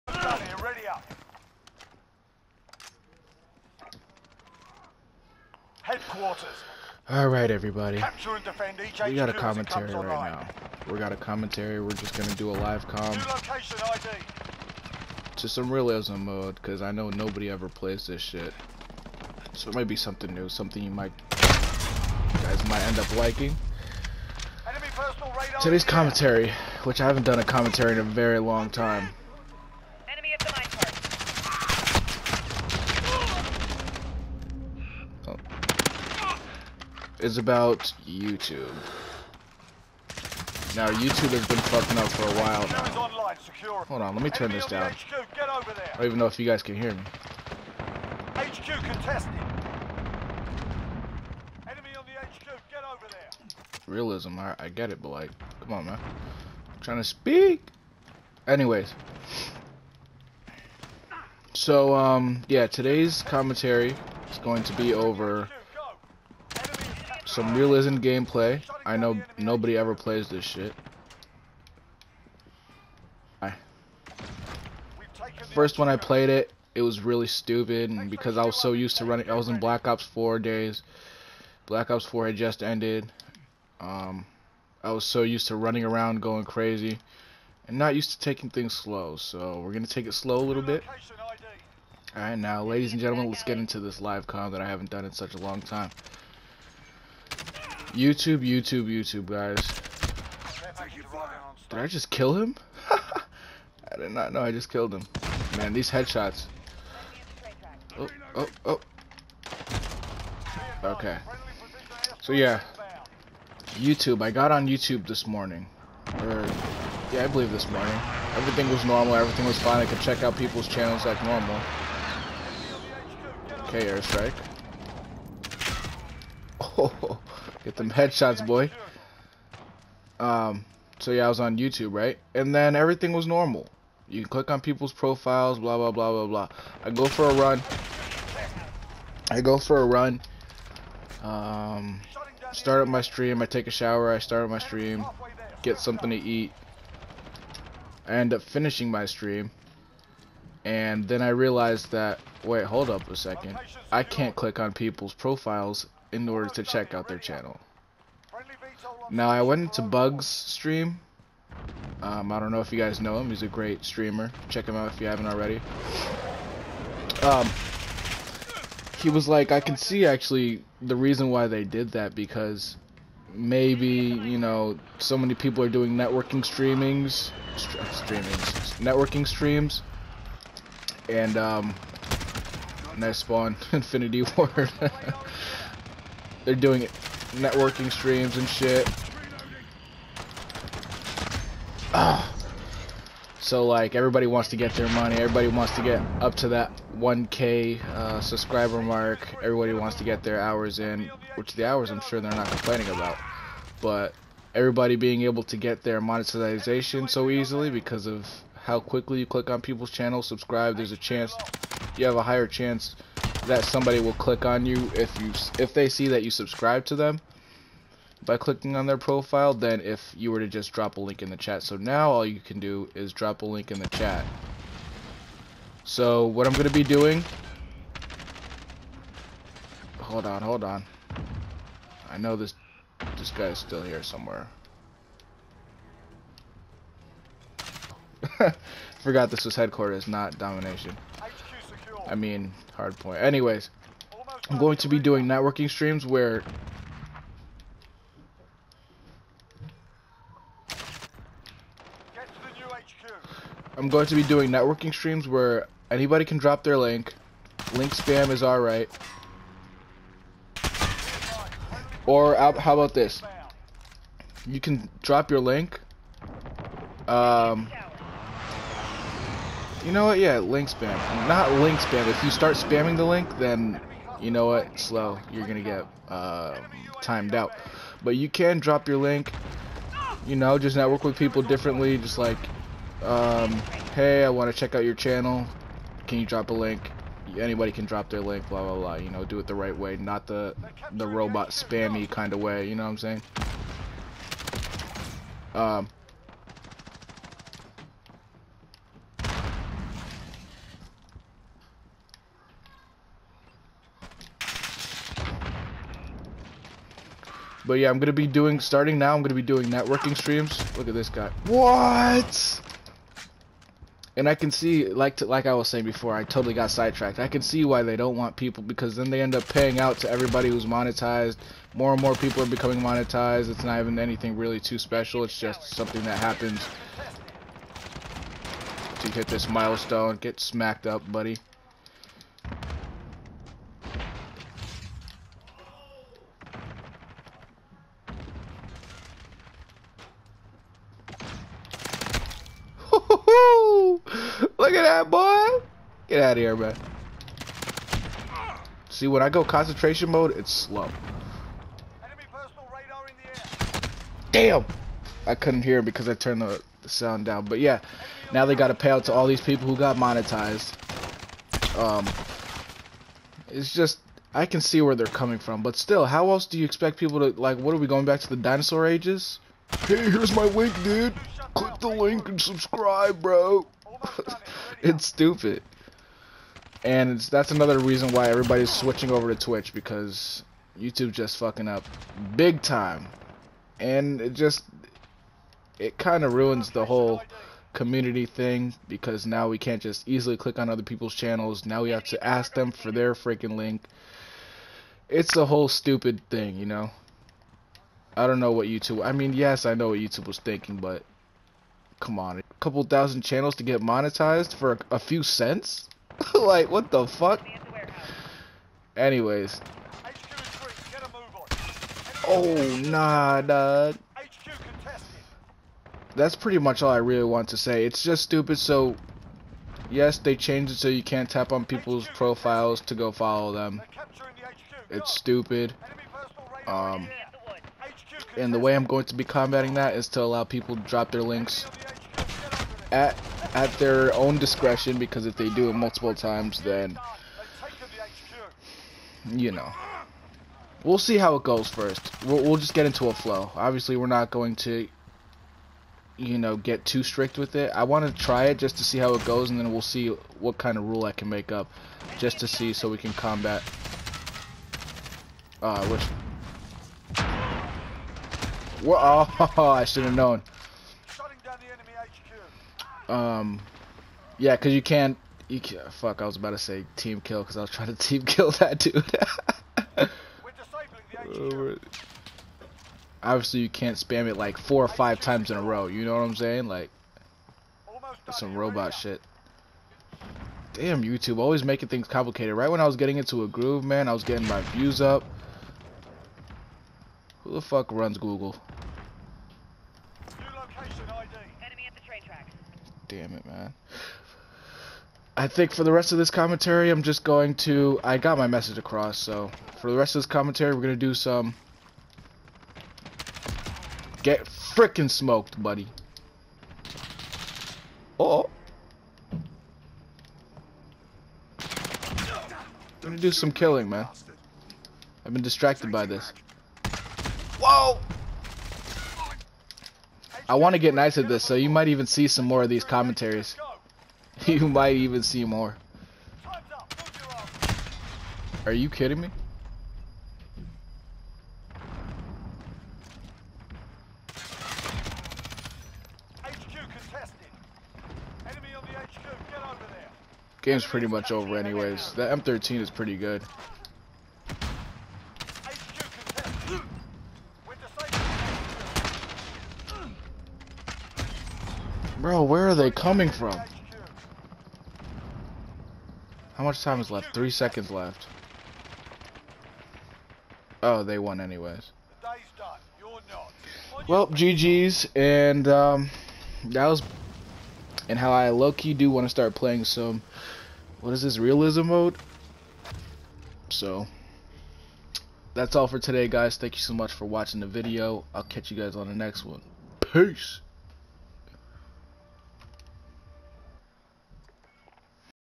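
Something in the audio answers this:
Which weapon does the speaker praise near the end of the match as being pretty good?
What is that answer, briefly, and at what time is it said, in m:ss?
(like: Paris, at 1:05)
M13, at 9:02.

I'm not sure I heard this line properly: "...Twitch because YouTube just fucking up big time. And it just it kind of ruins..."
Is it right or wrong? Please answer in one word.
right.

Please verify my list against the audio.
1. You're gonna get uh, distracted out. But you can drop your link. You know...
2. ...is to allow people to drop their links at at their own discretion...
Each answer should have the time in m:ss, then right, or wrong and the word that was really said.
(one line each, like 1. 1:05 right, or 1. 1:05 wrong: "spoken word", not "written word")
1. 4:35 wrong: "timed", not "distracted"
2. 7:09 right.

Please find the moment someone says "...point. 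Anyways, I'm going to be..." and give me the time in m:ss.
4:02.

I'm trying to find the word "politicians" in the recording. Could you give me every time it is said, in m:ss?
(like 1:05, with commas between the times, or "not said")
not said.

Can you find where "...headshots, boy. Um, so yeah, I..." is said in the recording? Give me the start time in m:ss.
2:07.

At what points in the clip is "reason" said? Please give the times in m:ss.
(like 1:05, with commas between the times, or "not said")
2:50, 6:17.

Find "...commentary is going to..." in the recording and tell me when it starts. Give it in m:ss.
1:03.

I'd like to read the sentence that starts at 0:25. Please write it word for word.
Today's commentary, which I haven't done a commentary in a very long time.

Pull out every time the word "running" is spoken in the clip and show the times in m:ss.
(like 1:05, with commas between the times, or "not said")
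1:19, 1:25.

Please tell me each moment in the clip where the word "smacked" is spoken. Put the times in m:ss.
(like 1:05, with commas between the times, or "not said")
5:30.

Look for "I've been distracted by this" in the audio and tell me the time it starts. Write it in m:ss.
8:35.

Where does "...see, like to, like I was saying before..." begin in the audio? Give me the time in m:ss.
5:14.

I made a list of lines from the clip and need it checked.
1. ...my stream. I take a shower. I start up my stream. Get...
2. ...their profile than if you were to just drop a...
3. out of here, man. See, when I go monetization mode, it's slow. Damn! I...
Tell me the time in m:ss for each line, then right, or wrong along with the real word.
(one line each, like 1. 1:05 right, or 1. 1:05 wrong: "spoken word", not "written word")
1. 2:22 right
2. 3:38 right
3. 5:46 wrong: "concentration", not "monetization".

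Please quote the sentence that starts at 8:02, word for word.
Right when I was getting into a groove, man, I was getting my views up.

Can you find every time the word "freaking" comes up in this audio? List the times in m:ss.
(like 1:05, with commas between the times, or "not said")
6:33, 8:24.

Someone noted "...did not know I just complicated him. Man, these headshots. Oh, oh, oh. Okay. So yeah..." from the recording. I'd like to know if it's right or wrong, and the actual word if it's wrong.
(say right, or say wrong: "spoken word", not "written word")
wrong: "killed", not "complicated".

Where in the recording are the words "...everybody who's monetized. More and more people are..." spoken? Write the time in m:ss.
5:20.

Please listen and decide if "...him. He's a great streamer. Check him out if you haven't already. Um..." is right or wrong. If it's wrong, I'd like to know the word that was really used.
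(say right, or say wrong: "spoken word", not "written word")
right.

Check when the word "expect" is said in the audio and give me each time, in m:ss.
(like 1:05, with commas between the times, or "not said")
6:06.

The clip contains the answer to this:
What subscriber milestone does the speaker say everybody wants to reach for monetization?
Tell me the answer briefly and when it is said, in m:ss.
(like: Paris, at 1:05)
1K, at 3:16.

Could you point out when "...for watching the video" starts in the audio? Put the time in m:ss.
9:37.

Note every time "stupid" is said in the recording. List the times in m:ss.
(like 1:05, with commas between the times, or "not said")
1:17, 6:15, 6:35, 6:58, 7:05.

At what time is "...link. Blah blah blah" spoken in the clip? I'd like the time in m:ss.
4:48.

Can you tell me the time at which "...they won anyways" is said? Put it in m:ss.
9:21.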